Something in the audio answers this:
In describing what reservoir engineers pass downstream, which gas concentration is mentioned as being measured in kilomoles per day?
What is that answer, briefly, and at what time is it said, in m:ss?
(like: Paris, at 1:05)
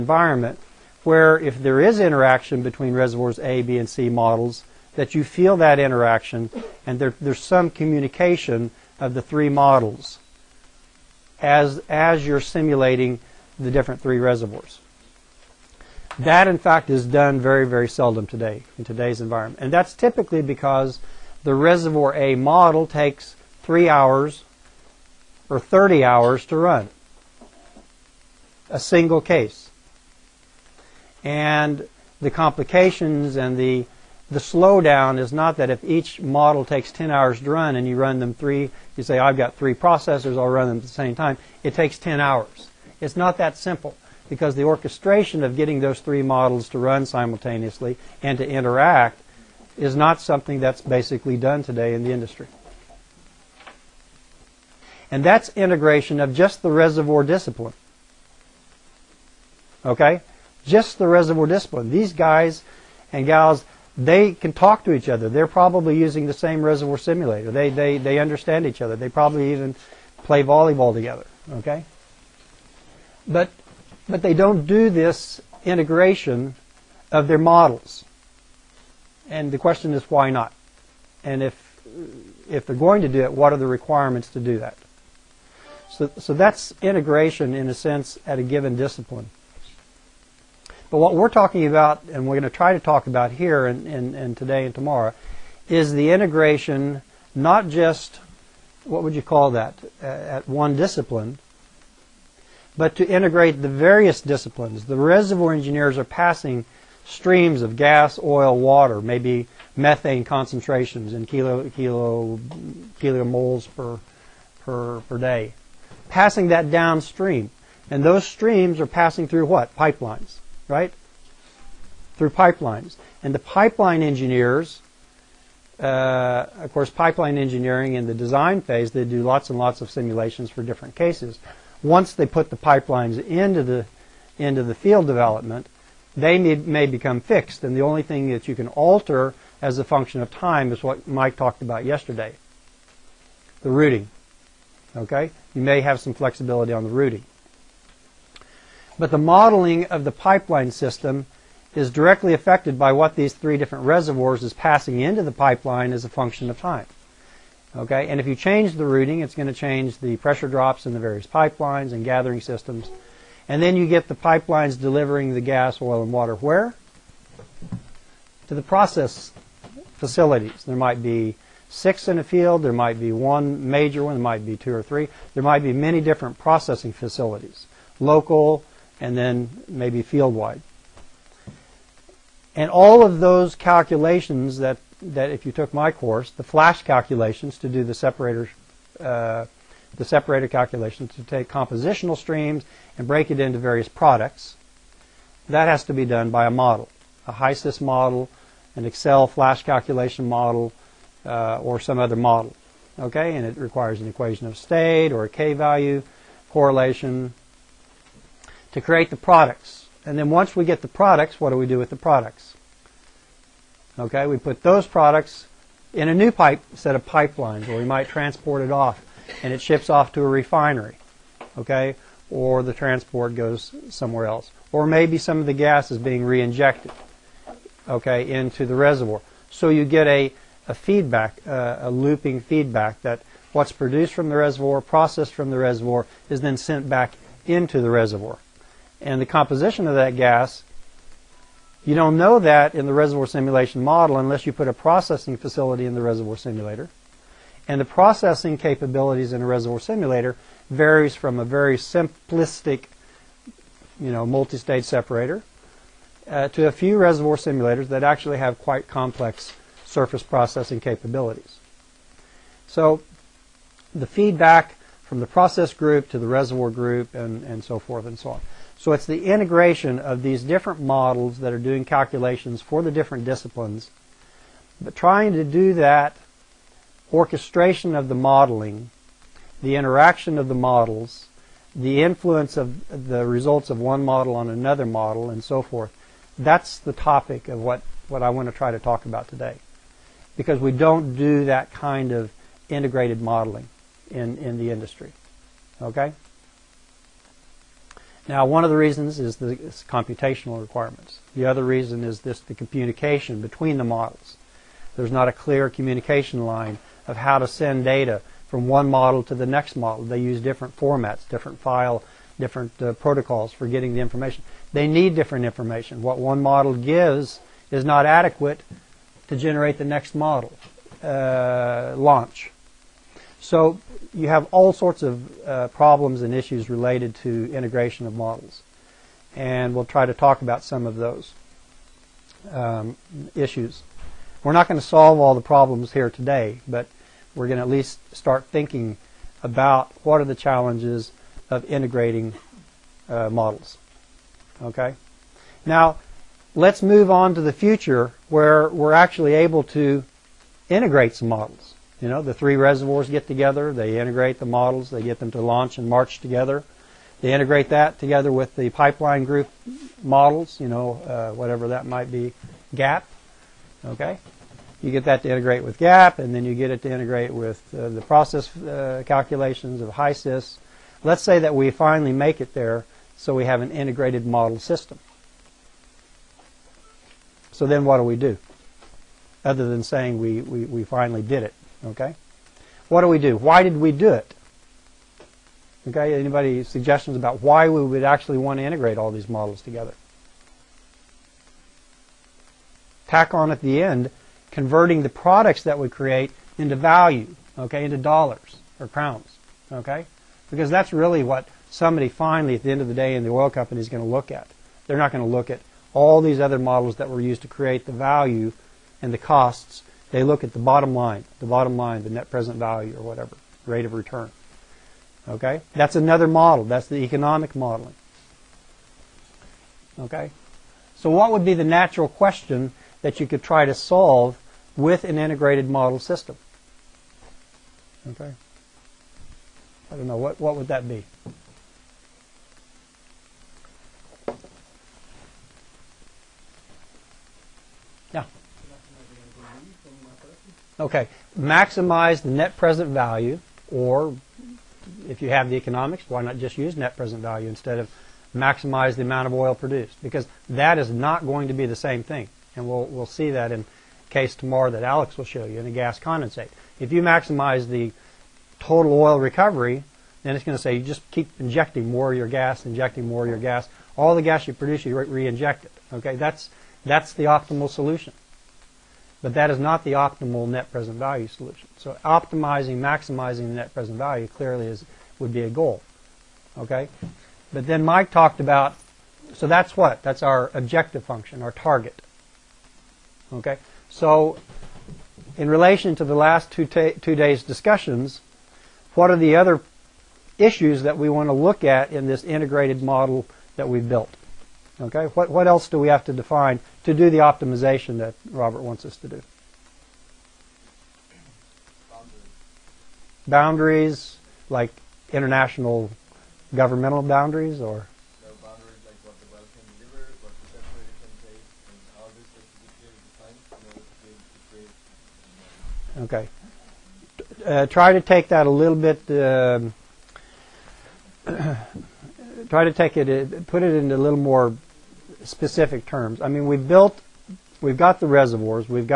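Methane, at 1:49.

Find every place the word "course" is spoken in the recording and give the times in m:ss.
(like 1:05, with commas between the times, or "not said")
2:06, 3:05.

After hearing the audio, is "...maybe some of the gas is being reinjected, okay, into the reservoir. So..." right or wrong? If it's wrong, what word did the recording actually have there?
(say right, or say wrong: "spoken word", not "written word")
right.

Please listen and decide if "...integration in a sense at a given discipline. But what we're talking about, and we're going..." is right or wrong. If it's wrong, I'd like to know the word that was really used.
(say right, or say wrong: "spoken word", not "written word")
right.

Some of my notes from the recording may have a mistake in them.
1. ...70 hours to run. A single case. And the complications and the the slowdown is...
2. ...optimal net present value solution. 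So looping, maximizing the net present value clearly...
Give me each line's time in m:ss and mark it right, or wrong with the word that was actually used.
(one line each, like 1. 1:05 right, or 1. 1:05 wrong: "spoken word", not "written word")
1. 0:25 wrong: "30", not "70"
2. 7:49 wrong: "optimizing", not "looping".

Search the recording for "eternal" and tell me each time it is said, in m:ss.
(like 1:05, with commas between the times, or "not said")
not said.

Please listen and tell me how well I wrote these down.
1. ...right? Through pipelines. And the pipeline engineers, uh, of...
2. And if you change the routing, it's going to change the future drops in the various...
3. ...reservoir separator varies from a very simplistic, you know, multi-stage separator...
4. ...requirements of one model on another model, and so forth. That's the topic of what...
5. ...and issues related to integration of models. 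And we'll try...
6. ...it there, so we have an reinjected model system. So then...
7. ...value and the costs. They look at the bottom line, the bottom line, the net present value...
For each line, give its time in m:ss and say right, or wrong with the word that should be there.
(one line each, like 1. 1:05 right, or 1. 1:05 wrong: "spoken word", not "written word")
1. 2:00 right
2. 2:38 wrong: "pressure", not "future"
3. 4:09 wrong: "simulator", not "separator"
4. 4:43 wrong: "results", not "requirements"
5. 5:26 right
6. 6:12 wrong: "integrated", not "reinjected"
7. 6:47 right.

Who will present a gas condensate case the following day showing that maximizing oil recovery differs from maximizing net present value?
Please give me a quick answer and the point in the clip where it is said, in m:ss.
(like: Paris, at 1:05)
Alex, at 7:34.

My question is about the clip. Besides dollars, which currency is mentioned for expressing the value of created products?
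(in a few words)
Crowns.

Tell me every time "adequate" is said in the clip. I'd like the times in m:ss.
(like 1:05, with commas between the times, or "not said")
5:18.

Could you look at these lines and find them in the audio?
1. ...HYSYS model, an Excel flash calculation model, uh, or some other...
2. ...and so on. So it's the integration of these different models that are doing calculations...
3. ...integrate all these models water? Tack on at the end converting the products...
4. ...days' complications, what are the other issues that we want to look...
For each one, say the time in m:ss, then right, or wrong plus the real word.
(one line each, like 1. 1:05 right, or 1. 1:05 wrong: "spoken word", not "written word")
1. 3:17 right
2. 4:28 right
3. 6:28 wrong: "together", not "water"
4. 8:07 wrong: "discussions", not "complications".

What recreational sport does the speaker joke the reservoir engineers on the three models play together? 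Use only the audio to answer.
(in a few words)
Volleyball.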